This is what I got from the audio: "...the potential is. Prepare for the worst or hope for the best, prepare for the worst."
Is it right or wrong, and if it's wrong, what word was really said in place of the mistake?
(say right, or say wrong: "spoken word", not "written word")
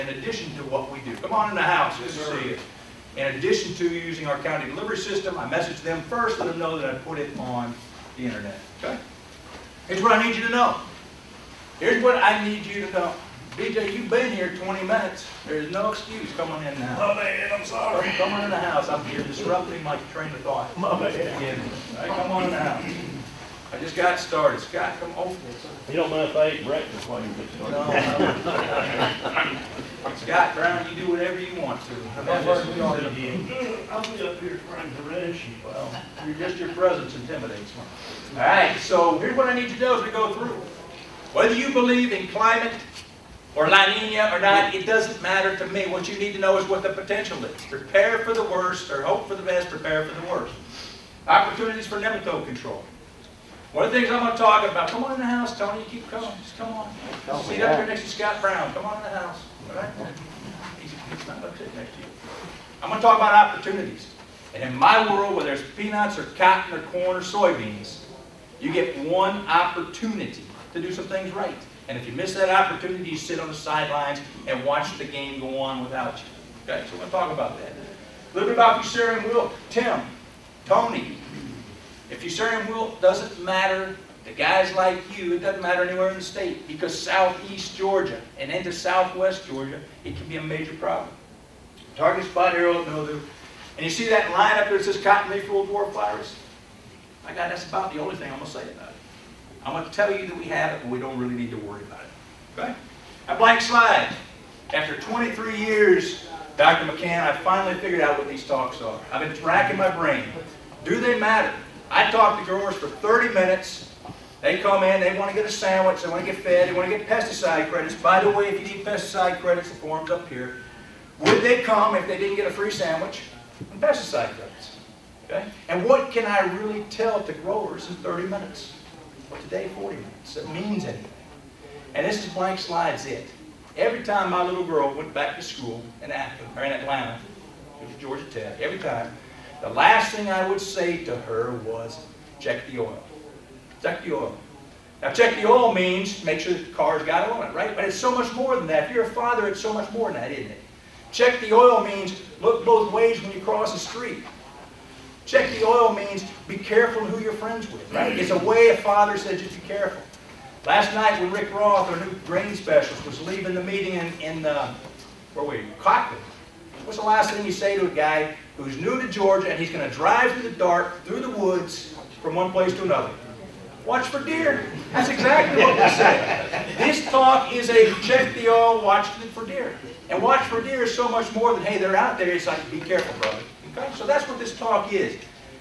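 right.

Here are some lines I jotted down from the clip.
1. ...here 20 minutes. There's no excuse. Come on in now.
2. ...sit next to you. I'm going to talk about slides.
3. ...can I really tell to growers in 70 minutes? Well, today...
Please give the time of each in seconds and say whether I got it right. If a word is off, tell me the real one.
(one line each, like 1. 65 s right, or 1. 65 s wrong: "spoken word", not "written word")
1. 14 s right
2. 61 s wrong: "opportunities", not "slides"
3. 126 s wrong: "30", not "70".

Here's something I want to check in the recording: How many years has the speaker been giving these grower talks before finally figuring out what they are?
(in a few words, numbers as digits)
23.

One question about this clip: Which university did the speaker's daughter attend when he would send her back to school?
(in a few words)
Georgia Tech.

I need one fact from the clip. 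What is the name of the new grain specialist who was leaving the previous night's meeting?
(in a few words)
Rick Roth.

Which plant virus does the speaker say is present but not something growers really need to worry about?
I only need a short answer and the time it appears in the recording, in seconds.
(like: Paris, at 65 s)
cotton leaf roll dwarf virus, at 95 s.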